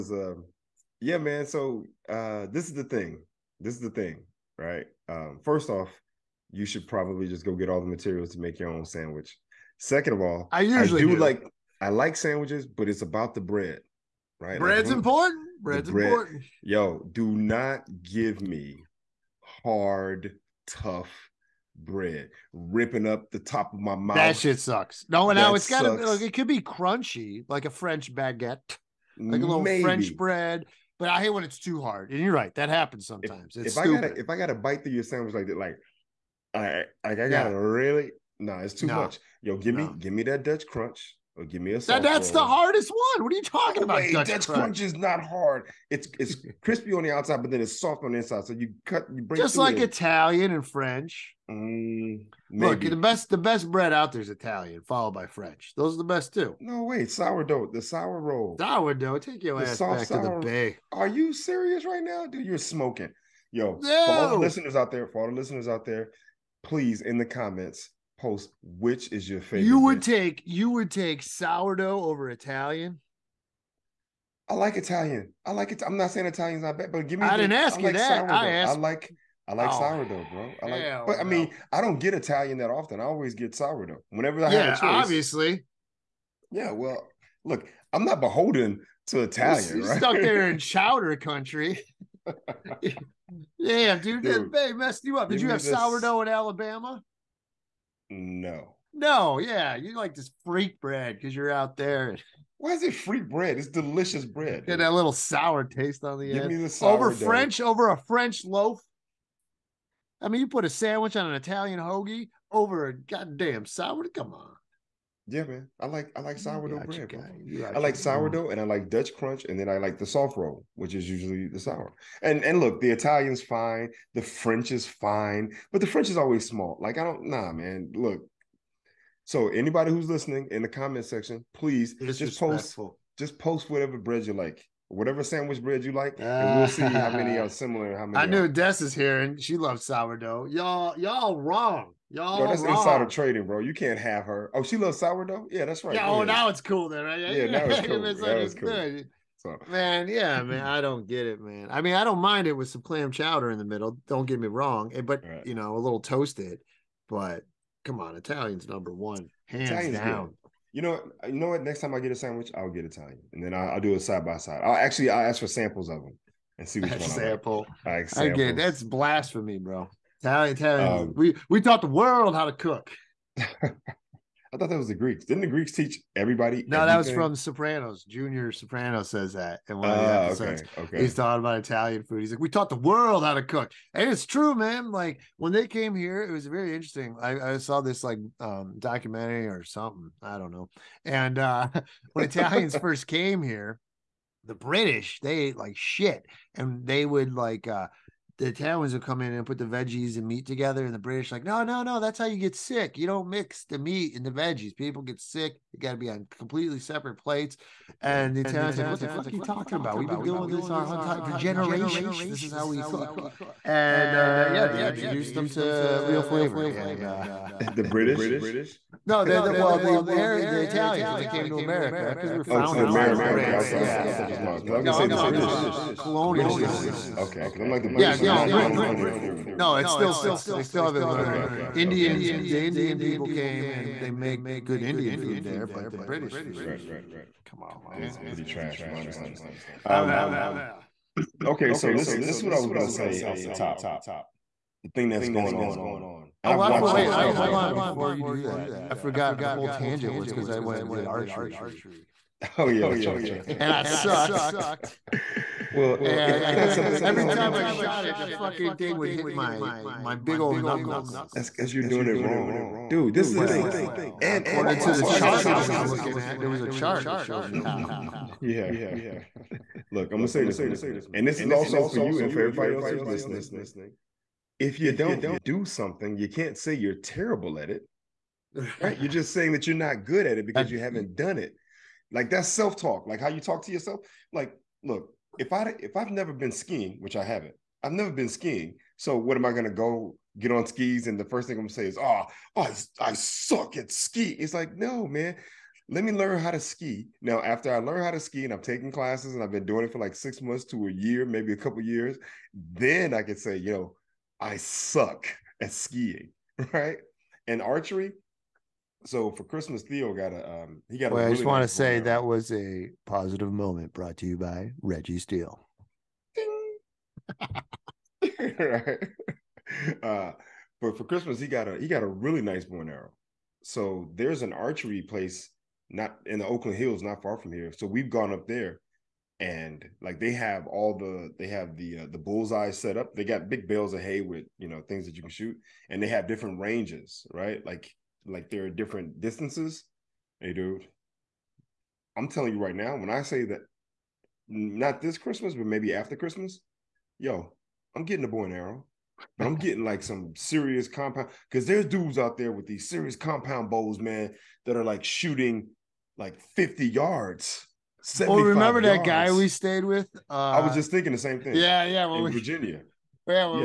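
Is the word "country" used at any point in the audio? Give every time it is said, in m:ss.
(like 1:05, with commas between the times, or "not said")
1:31.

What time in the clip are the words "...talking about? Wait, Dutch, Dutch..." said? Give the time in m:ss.
0:43.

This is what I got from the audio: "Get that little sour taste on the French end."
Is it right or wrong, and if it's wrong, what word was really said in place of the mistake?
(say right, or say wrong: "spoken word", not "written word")
wrong: "Give", not "French".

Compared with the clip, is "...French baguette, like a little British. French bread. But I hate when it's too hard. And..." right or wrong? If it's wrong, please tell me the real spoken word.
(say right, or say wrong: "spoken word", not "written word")
wrong: "Maybe", not "British".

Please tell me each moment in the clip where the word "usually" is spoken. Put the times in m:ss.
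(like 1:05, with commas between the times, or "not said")
0:10, 2:01.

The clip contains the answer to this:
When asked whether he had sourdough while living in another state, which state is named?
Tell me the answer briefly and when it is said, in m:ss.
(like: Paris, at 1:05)
Alabama, at 1:36.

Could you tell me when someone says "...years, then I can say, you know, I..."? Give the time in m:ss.
5:01.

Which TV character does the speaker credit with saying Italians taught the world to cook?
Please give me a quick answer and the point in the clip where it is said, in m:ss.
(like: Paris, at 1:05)
Junior Soprano, at 2:58.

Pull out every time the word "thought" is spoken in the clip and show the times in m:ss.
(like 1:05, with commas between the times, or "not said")
2:54, 3:44.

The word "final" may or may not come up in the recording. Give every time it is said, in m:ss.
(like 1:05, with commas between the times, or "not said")
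not said.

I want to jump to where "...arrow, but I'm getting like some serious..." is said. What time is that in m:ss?
5:48.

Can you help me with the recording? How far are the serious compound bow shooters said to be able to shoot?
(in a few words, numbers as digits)
50 yards.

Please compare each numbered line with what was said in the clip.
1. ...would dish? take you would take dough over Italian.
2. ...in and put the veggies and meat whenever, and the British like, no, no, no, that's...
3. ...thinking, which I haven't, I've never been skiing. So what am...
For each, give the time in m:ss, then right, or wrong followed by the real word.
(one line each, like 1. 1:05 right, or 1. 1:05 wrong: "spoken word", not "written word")
1. 1:09 wrong: "sourdough", not "dough"
2. 3:19 wrong: "together", not "whenever"
3. 4:46 wrong: "skiing", not "thinking".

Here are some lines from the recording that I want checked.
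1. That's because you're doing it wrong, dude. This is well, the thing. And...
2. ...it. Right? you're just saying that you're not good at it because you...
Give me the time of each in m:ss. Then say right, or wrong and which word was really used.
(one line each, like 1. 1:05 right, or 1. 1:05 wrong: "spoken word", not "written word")
1. 4:21 right
2. 4:37 right.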